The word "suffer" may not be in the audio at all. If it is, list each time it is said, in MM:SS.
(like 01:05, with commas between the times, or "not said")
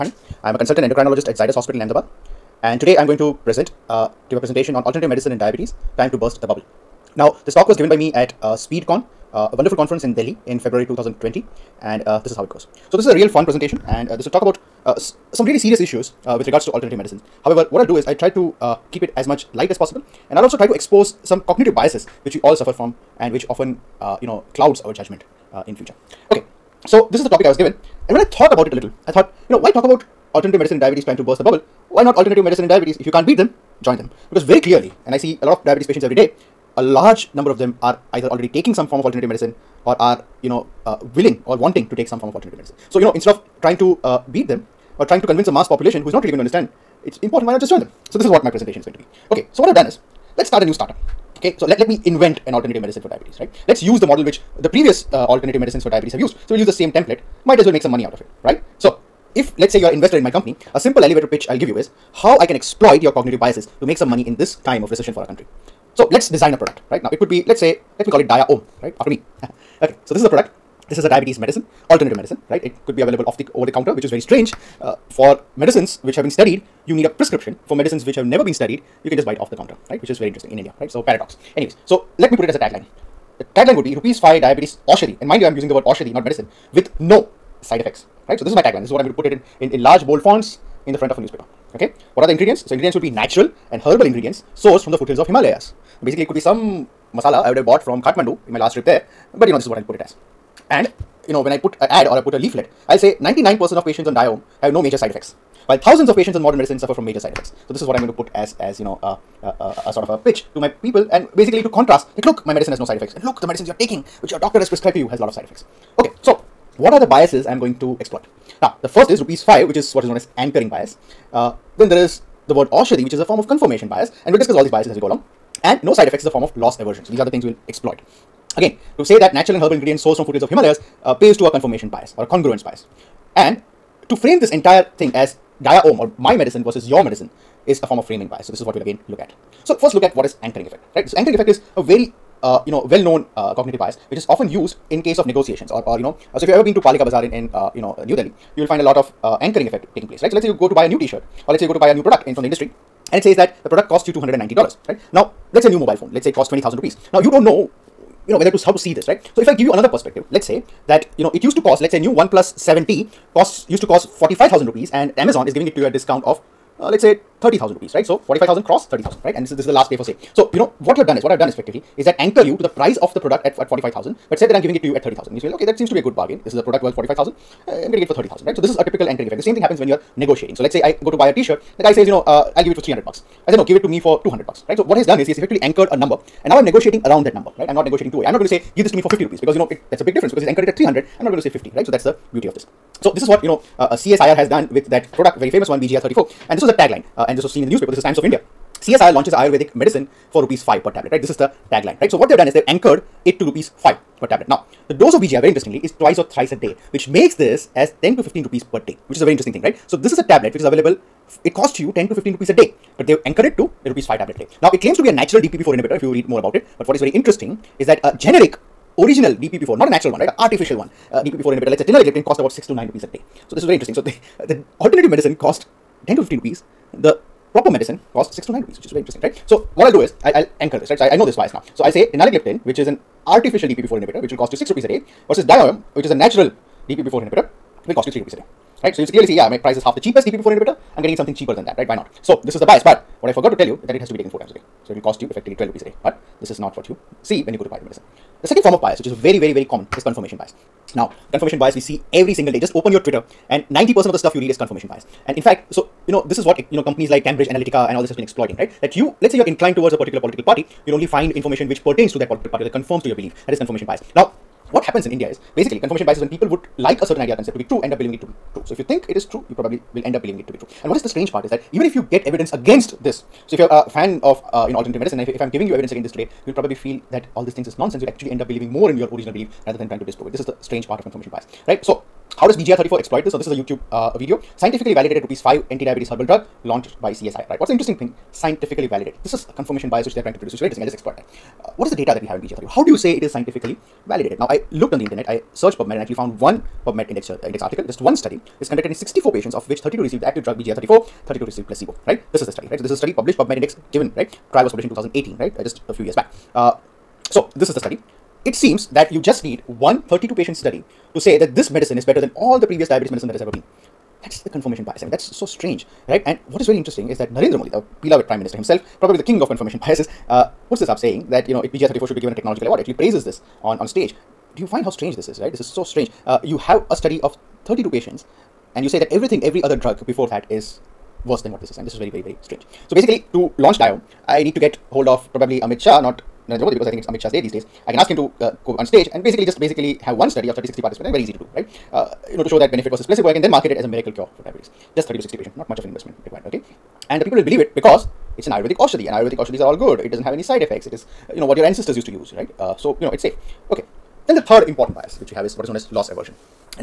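00:22, 01:46.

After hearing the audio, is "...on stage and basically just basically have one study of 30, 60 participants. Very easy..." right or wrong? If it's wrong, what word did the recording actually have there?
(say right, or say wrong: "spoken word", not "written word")
right.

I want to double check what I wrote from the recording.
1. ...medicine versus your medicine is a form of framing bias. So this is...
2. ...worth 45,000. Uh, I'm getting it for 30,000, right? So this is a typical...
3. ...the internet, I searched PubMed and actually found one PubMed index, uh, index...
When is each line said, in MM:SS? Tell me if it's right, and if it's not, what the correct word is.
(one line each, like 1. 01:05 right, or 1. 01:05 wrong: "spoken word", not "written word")
1. 02:16 right
2. 02:56 right
3. 04:54 right.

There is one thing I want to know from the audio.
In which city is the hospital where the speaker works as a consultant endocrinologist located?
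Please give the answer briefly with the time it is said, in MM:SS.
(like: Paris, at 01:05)
Ahmedabad, at 00:01.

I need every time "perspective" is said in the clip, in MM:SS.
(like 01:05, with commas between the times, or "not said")
02:39.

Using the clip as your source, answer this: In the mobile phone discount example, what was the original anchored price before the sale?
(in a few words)
45,000 rupees.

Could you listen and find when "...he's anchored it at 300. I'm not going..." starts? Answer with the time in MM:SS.
03:10.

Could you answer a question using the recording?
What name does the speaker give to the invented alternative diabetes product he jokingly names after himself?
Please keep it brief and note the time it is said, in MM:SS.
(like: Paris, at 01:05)
Dia Om, at 01:08.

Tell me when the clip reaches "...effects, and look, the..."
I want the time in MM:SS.
01:52.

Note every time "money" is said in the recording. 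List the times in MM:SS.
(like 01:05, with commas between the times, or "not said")
00:57, 01:04.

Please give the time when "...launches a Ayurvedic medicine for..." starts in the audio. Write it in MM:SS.
03:19.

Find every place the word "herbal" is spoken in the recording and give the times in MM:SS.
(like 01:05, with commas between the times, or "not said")
01:33, 02:09, 04:46.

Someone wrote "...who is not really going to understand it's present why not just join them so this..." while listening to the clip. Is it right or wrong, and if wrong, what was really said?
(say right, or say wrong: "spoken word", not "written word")
wrong: "important", not "present".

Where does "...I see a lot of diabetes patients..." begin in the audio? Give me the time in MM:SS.
00:35.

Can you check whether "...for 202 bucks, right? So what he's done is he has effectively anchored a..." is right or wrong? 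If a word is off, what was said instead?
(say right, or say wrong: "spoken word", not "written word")
wrong: "200", not "202".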